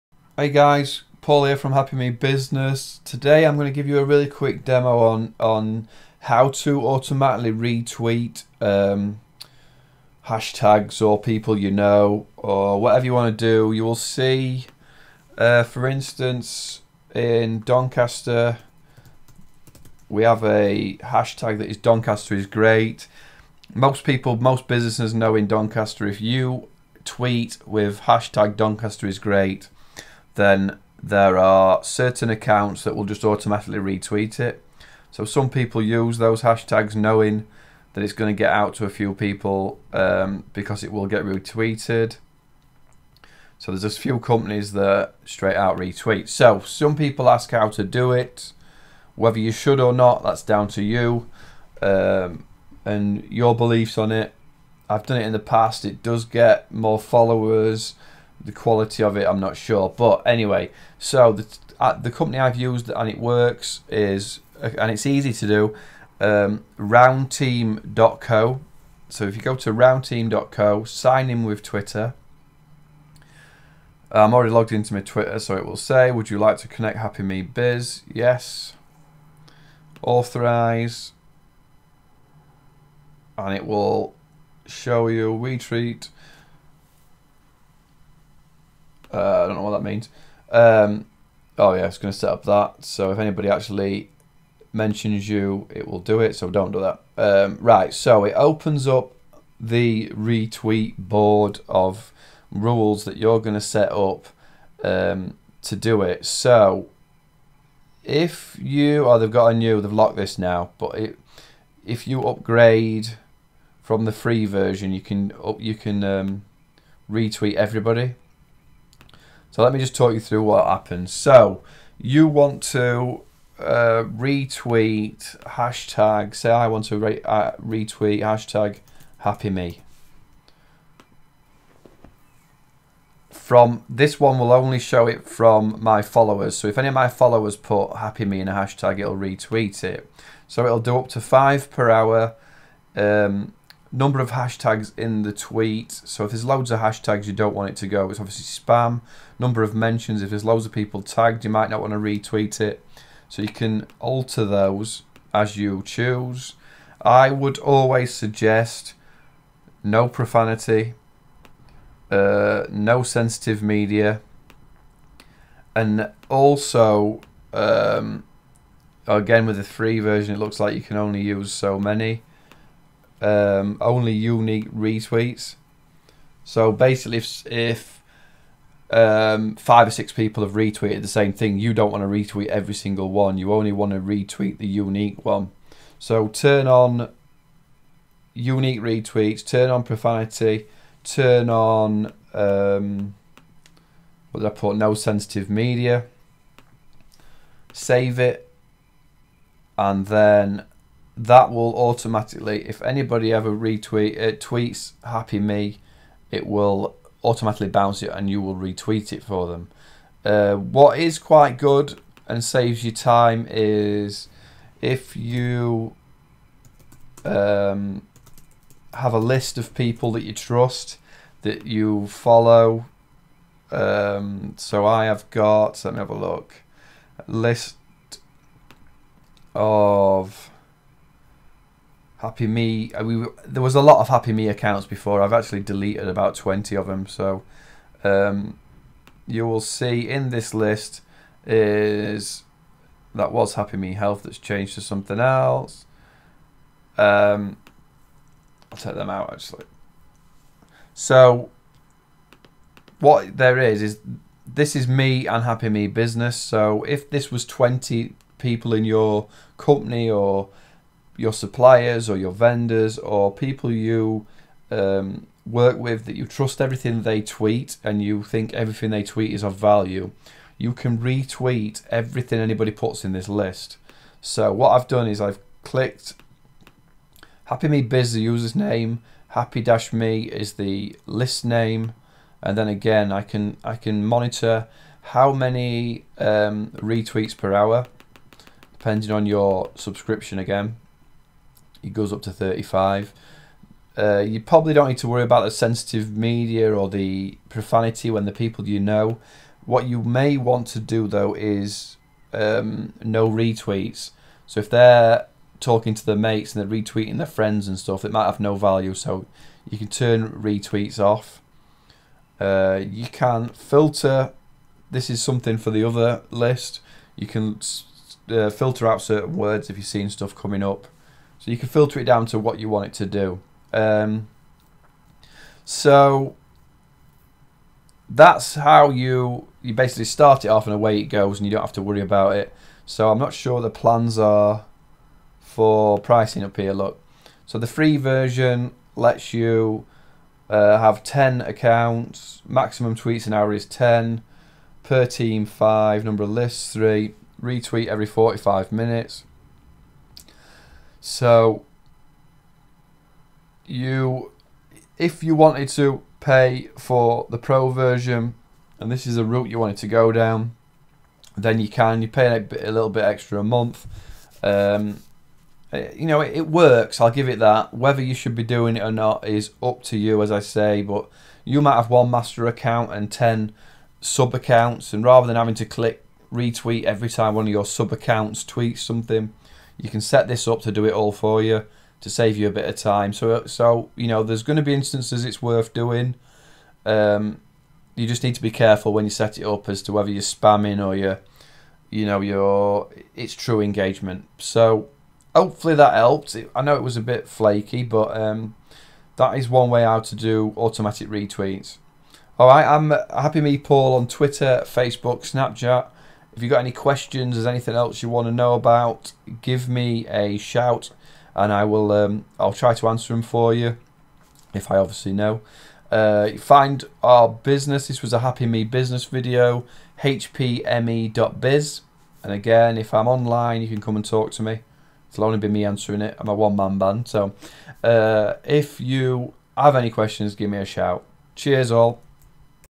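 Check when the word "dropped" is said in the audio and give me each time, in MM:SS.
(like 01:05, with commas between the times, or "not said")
not said.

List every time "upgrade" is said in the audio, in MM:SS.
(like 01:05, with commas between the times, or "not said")
01:52.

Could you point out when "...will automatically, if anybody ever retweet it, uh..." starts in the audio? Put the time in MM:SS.
03:21.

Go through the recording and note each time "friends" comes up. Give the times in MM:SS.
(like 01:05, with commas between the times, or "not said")
05:07.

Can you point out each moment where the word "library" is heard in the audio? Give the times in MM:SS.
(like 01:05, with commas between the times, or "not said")
not said.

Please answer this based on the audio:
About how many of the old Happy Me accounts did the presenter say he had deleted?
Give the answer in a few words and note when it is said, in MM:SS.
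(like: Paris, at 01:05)
20, at 03:56.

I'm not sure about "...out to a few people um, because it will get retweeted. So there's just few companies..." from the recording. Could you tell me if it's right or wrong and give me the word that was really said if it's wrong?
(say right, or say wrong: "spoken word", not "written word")
right.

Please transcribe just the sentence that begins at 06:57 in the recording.
This was a Happy Me business video, hpme.biz.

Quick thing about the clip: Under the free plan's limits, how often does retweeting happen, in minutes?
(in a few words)
every 45 minutes.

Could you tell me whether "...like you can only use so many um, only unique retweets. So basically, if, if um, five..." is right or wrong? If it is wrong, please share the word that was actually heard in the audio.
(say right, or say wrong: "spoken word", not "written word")
right.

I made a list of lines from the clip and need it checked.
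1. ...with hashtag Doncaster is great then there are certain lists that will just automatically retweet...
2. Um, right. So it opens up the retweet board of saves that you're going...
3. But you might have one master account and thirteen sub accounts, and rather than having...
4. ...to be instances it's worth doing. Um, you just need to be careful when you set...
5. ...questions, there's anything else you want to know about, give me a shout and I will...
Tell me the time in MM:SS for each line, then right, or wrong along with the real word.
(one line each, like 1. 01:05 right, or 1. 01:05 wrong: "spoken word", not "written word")
1. 00:27 wrong: "accounts", not "lists"
2. 01:37 wrong: "rules", not "saves"
3. 06:10 wrong: "ten", not "thirteen"
4. 06:24 right
5. 06:46 right.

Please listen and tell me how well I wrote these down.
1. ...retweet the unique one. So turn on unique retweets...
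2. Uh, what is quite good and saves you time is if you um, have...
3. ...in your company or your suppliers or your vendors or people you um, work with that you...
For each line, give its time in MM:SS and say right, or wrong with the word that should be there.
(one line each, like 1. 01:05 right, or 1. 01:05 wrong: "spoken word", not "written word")
1. 03:03 right
2. 03:30 right
3. 04:18 right.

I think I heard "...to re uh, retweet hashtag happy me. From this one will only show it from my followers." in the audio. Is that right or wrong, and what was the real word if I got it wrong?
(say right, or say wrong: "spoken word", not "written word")
right.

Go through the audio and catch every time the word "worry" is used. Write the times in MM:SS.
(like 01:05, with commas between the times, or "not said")
04:55, 05:31.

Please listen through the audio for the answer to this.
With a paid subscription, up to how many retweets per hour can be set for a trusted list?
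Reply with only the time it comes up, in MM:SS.
04:52.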